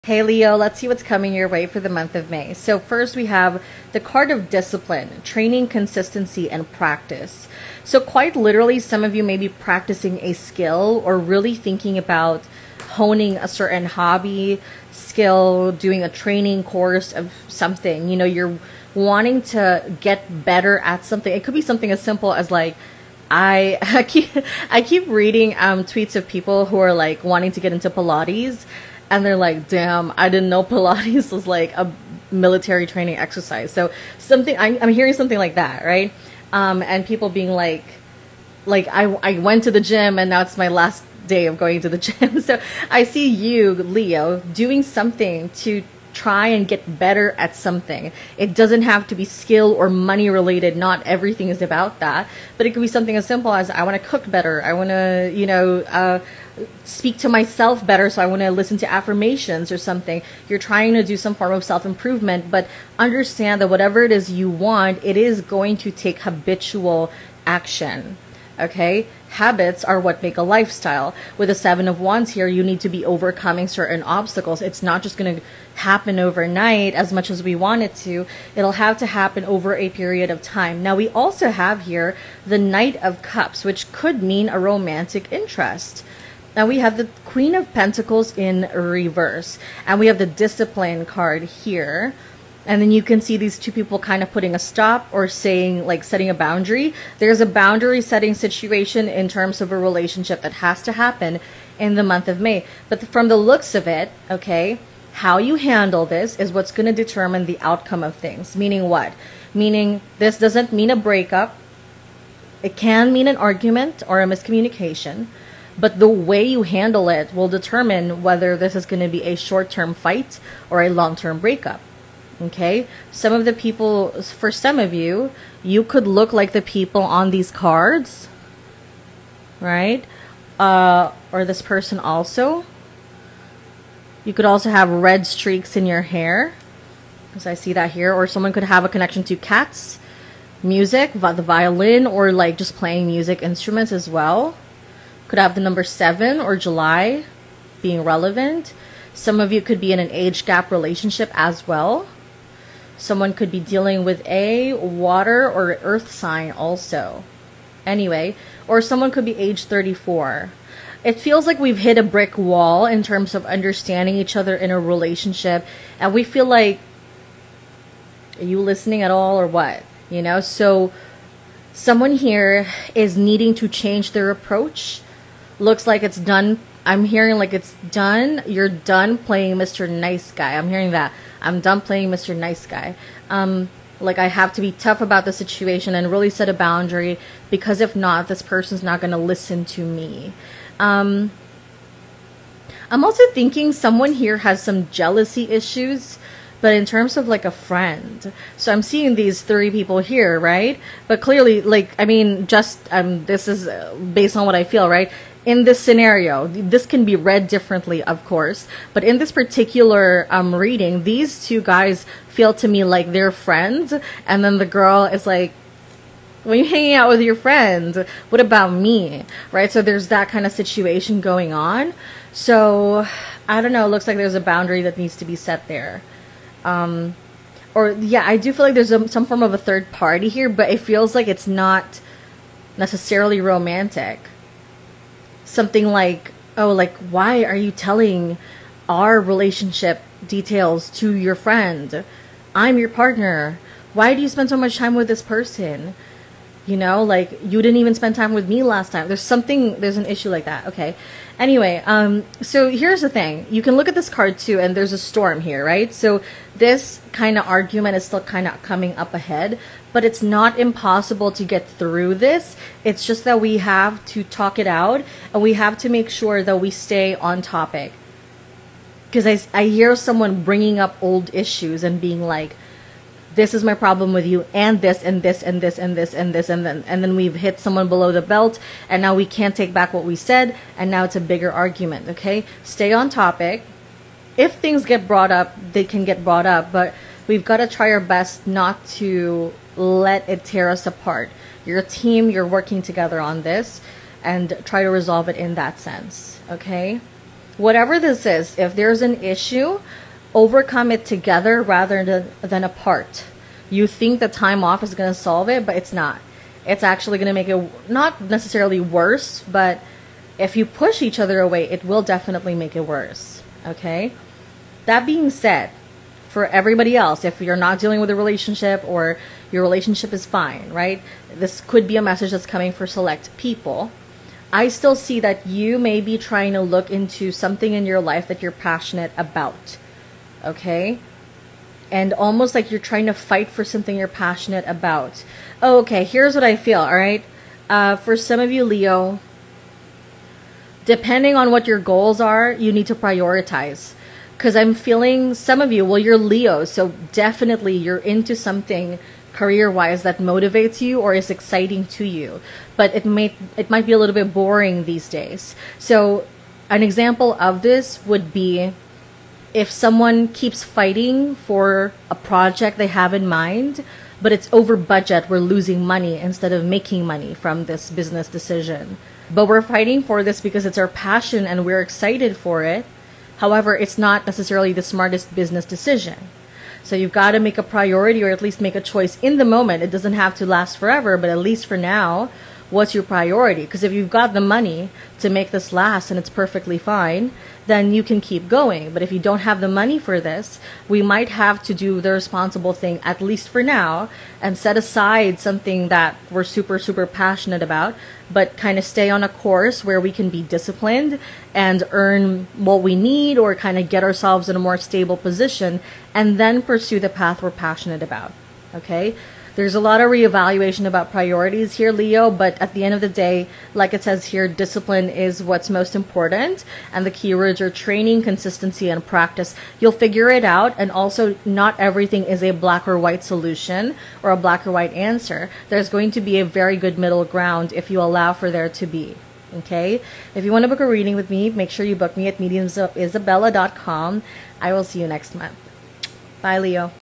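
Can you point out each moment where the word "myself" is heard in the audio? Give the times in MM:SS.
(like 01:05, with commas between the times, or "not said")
00:57.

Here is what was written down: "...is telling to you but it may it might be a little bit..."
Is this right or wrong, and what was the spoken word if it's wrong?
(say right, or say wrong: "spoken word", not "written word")
wrong: "exciting", not "telling".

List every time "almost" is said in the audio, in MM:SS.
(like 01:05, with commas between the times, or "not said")
05:32.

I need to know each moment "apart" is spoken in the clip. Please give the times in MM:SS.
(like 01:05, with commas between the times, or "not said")
04:50, 05:02.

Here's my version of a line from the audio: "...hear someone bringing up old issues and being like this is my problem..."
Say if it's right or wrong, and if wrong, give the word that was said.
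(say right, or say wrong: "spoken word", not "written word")
right.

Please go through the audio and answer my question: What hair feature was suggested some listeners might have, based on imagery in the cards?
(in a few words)
Red streaks.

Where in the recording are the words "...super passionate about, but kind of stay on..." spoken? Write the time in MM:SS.
06:36.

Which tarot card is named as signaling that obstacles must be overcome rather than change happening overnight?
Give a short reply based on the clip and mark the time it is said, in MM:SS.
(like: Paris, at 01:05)
Seven of Wands, at 01:11.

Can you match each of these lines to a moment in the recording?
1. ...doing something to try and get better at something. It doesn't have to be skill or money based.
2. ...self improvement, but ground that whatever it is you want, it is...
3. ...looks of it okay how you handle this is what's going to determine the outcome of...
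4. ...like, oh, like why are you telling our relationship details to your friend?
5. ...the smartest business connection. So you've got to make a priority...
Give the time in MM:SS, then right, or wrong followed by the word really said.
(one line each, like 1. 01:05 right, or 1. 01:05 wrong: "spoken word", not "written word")
1. 00:44 wrong: "related", not "based"
2. 01:01 wrong: "understand", not "ground"
3. 01:43 right
4. 03:55 right
5. 06:14 wrong: "decision", not "connection".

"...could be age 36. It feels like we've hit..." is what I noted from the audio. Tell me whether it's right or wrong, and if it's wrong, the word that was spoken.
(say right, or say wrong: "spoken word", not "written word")
wrong: "34", not "36".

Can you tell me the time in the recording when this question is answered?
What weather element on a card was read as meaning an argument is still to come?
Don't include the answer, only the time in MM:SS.
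04:14.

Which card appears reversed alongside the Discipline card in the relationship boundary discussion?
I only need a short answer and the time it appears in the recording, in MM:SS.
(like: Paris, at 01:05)
Queen of Pentacles, at 01:27.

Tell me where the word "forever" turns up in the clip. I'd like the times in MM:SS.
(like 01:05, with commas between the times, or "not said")
06:20.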